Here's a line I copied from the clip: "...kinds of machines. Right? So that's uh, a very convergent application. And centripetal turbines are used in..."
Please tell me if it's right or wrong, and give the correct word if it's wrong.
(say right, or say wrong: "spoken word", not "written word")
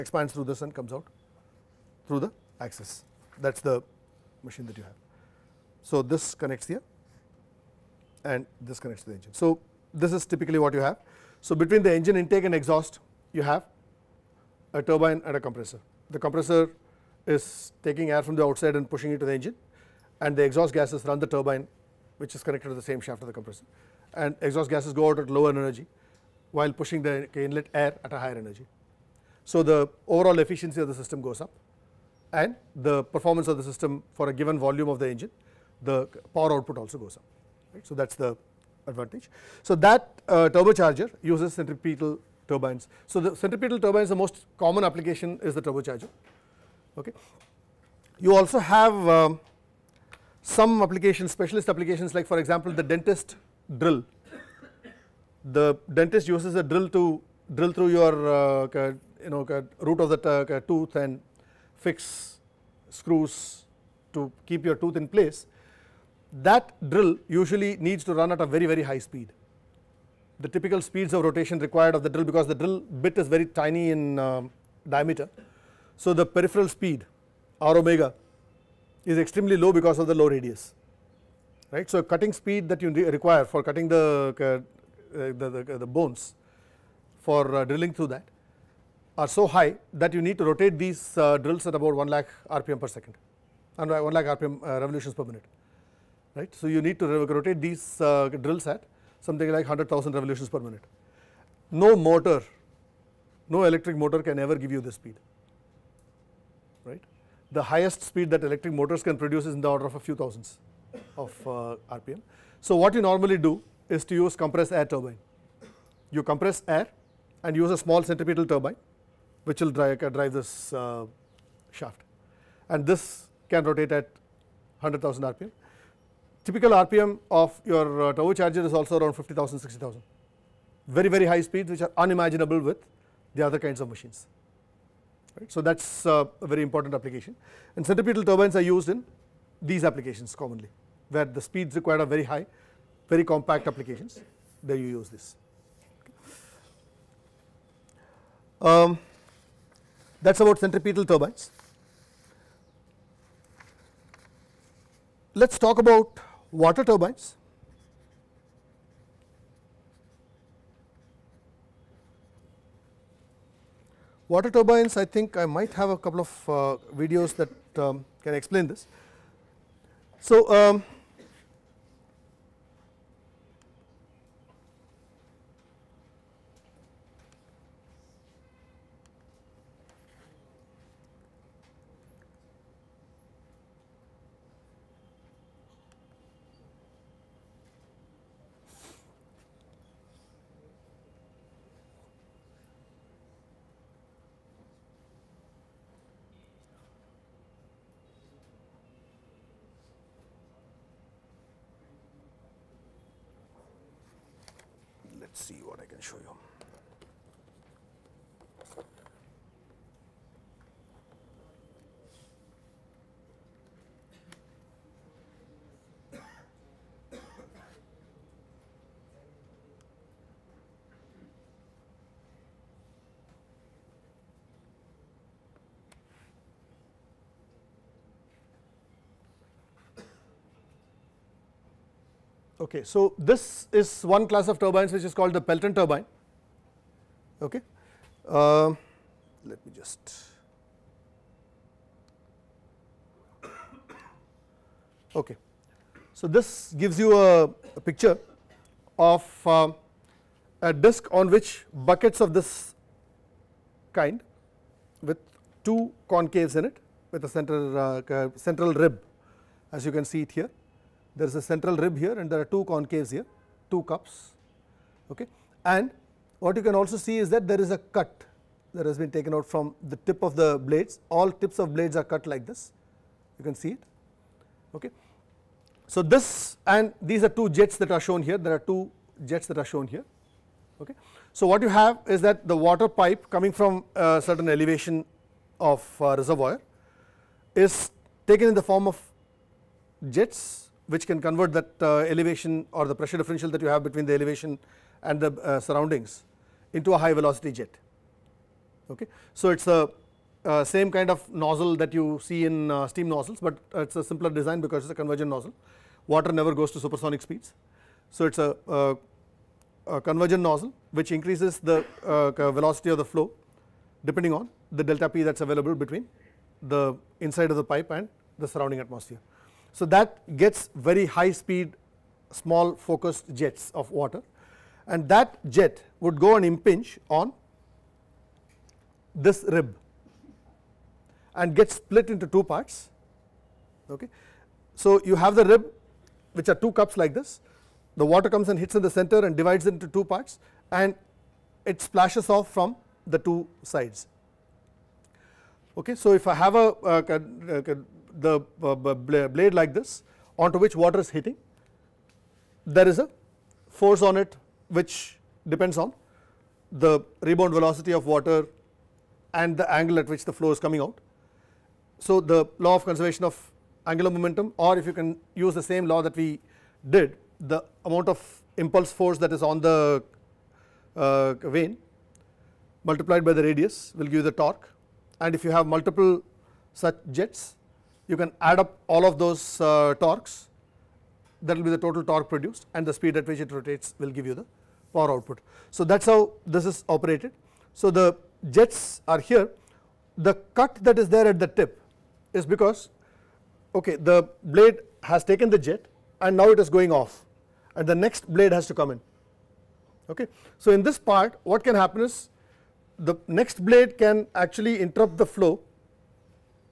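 wrong: "important", not "convergent".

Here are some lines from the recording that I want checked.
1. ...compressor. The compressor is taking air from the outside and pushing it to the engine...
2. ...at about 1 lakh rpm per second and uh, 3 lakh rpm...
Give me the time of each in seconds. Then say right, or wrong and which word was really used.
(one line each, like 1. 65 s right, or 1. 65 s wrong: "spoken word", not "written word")
1. 15 s right
2. 91 s wrong: "1", not "3".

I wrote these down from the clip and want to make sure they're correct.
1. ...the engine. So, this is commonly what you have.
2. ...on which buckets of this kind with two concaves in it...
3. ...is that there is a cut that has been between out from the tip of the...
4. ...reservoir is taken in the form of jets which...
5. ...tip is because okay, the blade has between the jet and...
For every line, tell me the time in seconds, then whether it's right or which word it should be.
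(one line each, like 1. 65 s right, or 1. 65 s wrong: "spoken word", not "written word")
1. 9 s wrong: "typically", not "commonly"
2. 251 s right
3. 267 s wrong: "taken", not "between"
4. 286 s right
5. 391 s wrong: "taken", not "between".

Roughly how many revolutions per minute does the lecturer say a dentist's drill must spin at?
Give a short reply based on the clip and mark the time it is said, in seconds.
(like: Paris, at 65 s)
100,000, at 99 s.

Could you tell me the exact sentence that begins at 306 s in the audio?
Water never goes to supersonic speeds.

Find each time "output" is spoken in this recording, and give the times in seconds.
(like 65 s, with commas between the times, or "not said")
36 s, 385 s.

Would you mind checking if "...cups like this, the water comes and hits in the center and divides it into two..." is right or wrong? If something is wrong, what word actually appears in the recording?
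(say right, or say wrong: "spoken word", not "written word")
right.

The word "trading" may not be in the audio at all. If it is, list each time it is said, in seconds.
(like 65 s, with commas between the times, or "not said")
not said.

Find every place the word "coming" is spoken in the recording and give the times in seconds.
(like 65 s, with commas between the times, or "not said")
283 s, 360 s.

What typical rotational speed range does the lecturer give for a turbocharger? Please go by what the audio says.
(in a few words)
50,000 to 60,000 RPM.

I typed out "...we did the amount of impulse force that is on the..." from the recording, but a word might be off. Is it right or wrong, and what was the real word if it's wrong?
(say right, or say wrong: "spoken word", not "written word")
right.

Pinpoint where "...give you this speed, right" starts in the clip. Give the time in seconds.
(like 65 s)
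104 s.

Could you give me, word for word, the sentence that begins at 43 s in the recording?
So the centripetal turbines, the most common application is the turbocharger.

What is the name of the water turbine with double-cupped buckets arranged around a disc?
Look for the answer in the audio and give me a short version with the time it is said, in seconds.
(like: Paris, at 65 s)
Pelton turbine, at 235 s.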